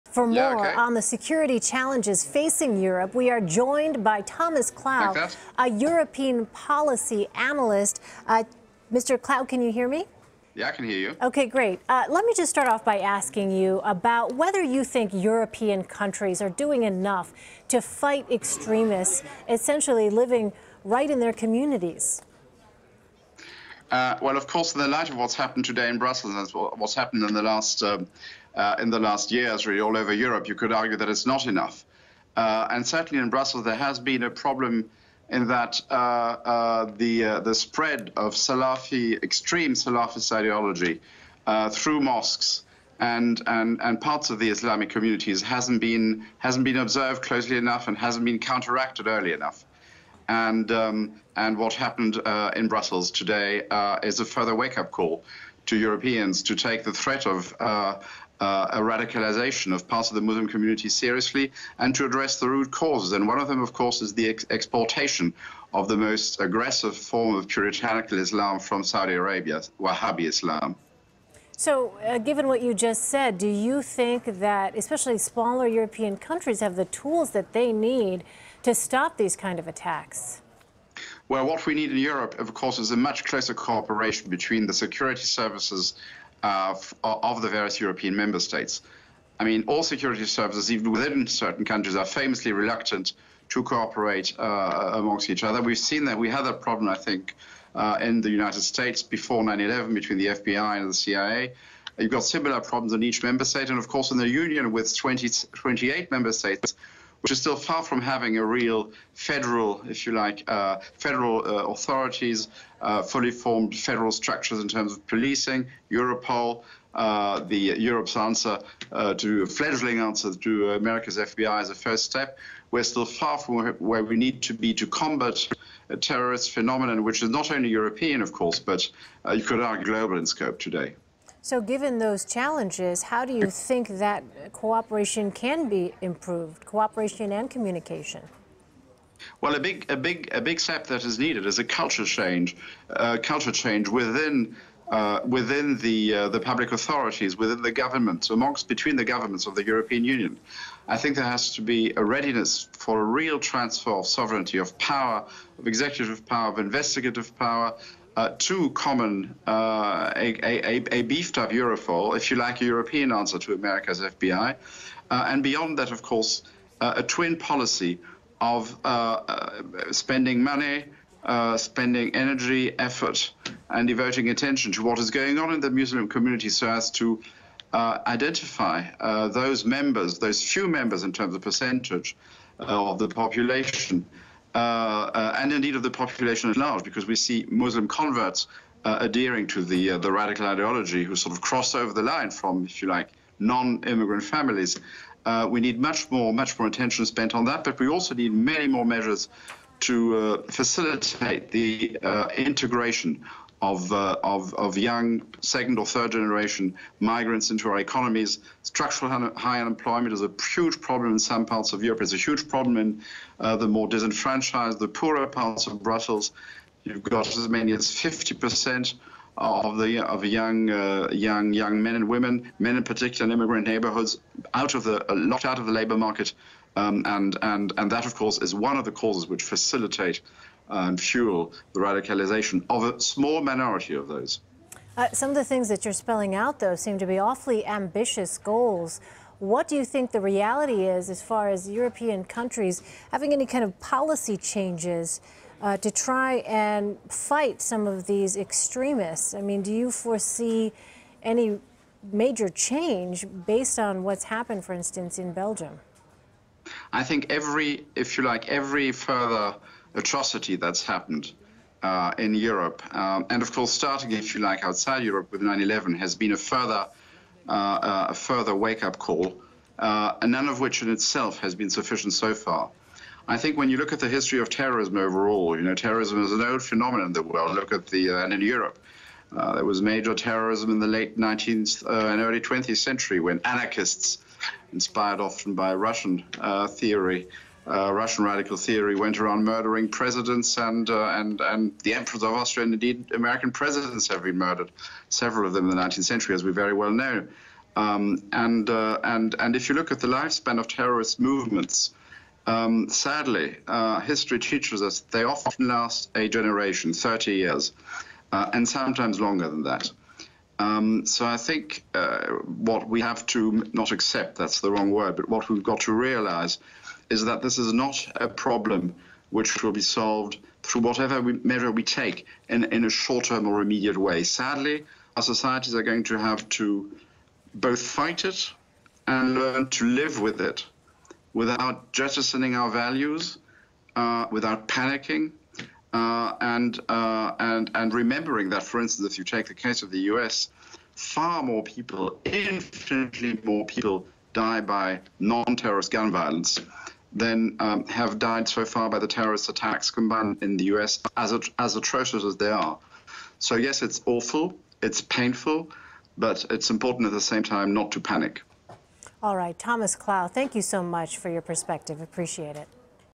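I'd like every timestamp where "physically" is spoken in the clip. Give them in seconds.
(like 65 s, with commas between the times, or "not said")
not said.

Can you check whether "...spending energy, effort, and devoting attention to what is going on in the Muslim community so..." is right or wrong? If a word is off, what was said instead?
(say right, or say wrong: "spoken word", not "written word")
right.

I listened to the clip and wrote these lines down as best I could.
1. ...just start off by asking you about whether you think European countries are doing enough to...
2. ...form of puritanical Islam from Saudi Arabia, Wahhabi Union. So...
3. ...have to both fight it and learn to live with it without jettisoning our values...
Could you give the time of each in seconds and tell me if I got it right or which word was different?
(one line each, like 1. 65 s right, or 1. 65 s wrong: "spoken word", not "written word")
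1. 12 s right
2. 66 s wrong: "Islam", not "Union"
3. 326 s right.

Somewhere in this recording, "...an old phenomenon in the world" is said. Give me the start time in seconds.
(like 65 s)
276 s.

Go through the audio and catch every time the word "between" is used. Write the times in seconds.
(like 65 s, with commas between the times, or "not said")
84 s, 99 s, 148 s.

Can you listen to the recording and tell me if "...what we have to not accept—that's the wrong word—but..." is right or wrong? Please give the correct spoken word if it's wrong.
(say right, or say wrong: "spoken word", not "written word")
right.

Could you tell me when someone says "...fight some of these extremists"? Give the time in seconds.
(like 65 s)
247 s.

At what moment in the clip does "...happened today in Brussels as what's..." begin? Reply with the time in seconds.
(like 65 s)
25 s.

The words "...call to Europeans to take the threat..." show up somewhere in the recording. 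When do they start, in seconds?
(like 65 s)
54 s.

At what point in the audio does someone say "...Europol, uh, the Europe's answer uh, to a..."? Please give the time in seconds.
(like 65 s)
115 s.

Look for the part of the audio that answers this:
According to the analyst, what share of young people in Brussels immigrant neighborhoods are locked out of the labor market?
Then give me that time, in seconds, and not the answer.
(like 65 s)
217 s.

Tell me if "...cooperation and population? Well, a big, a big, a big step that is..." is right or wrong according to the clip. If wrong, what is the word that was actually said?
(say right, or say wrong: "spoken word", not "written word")
wrong: "communication", not "population".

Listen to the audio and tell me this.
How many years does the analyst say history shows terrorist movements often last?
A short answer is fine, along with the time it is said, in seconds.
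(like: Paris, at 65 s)
30 years, at 306 s.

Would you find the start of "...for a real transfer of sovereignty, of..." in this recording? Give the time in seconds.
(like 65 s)
152 s.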